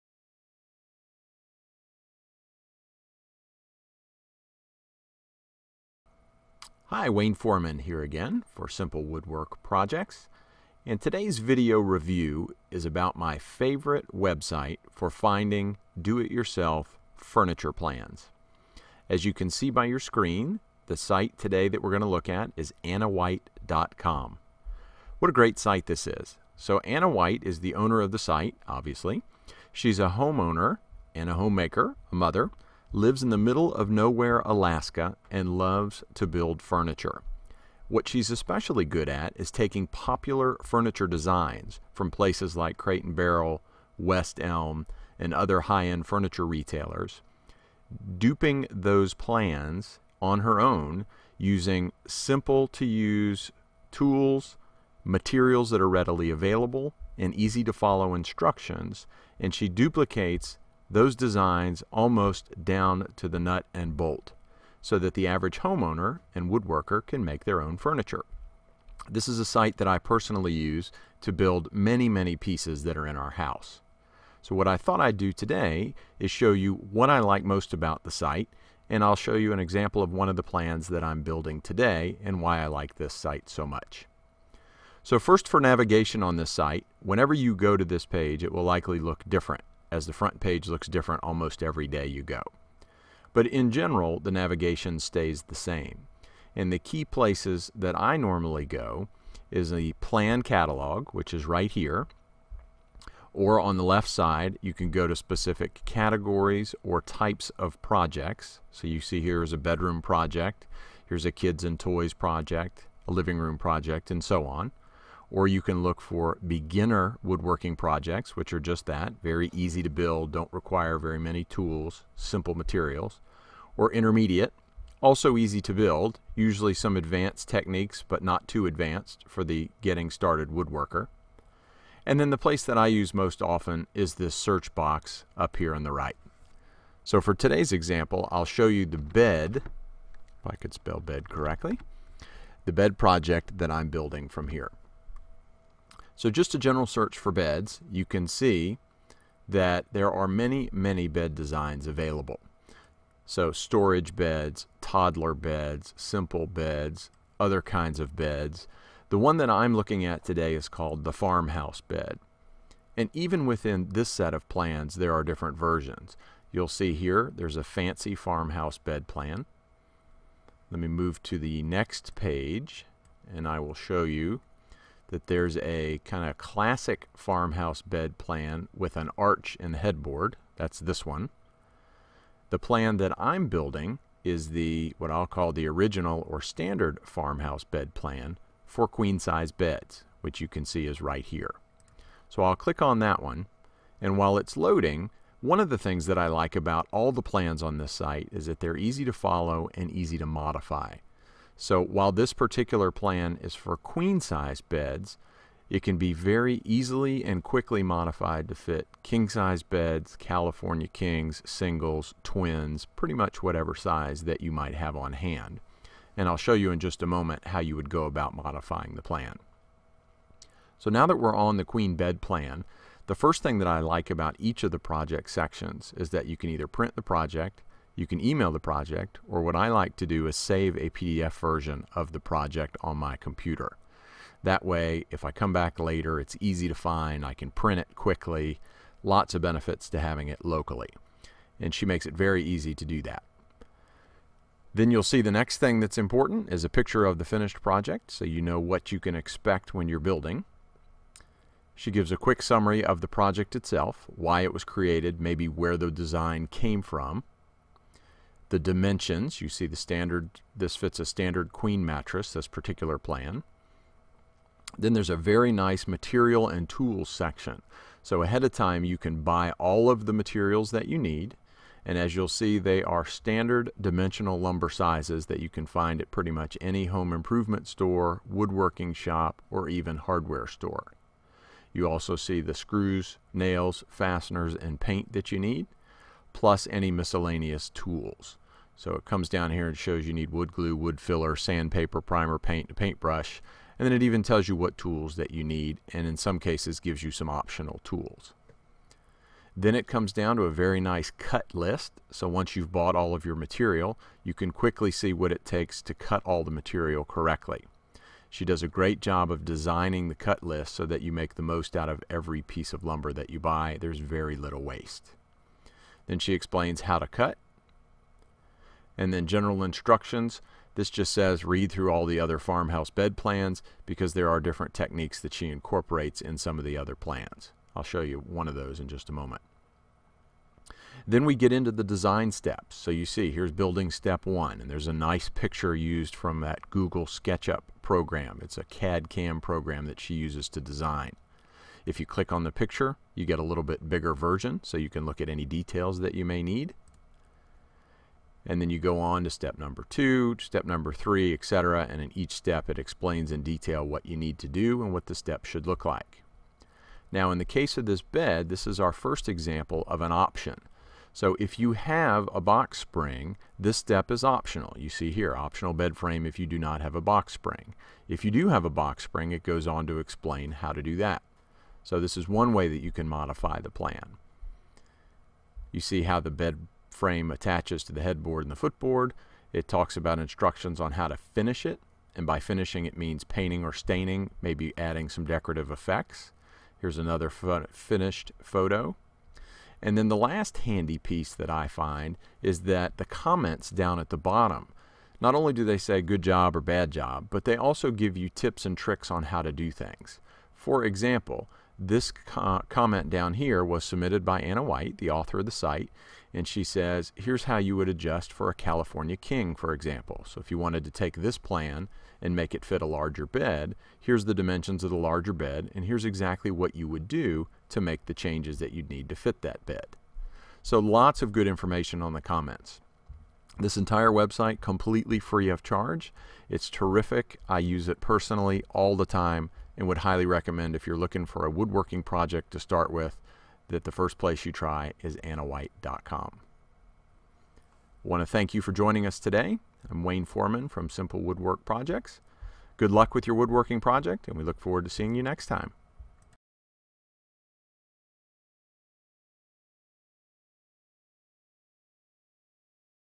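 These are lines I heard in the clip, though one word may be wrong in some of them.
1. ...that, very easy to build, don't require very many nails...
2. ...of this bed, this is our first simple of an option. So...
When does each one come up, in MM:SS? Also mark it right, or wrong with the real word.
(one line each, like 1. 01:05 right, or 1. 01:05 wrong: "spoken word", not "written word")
1. 01:58 wrong: "tools", not "nails"
2. 05:57 wrong: "example", not "simple".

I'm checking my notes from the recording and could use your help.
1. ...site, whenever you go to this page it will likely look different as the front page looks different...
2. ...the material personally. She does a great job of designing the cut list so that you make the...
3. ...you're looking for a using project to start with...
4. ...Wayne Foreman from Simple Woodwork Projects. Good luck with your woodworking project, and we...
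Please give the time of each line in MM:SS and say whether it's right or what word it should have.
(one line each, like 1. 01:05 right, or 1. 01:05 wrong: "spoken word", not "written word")
1. 01:26 right
2. 05:06 wrong: "correctly", not "personally"
3. 07:10 wrong: "woodworking", not "using"
4. 07:20 right.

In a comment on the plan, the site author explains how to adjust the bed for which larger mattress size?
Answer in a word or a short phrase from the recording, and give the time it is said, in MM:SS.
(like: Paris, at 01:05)
California king, at 06:48.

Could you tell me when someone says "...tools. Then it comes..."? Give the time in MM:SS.
04:57.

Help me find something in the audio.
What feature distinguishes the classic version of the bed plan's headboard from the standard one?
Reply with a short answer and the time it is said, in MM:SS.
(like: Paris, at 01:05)
An arch, at 02:58.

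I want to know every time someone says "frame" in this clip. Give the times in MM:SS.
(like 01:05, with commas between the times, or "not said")
06:05, 06:16.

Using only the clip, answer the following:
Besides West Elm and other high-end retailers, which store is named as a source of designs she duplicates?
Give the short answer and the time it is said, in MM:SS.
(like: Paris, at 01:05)
Crate and Barrel, at 00:42.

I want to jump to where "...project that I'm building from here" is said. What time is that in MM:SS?
02:22.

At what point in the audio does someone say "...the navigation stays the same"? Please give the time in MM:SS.
01:34.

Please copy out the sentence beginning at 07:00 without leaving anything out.
So lots of good information on the comments.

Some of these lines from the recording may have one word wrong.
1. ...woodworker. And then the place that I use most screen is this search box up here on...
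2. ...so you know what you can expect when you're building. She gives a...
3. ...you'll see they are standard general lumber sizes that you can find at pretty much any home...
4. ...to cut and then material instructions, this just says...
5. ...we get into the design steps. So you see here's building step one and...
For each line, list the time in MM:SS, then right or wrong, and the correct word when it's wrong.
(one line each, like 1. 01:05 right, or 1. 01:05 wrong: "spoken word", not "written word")
1. 02:10 wrong: "often", not "screen"
2. 04:08 right
3. 04:32 wrong: "dimensional", not "general"
4. 05:16 wrong: "general", not "material"
5. 05:31 right.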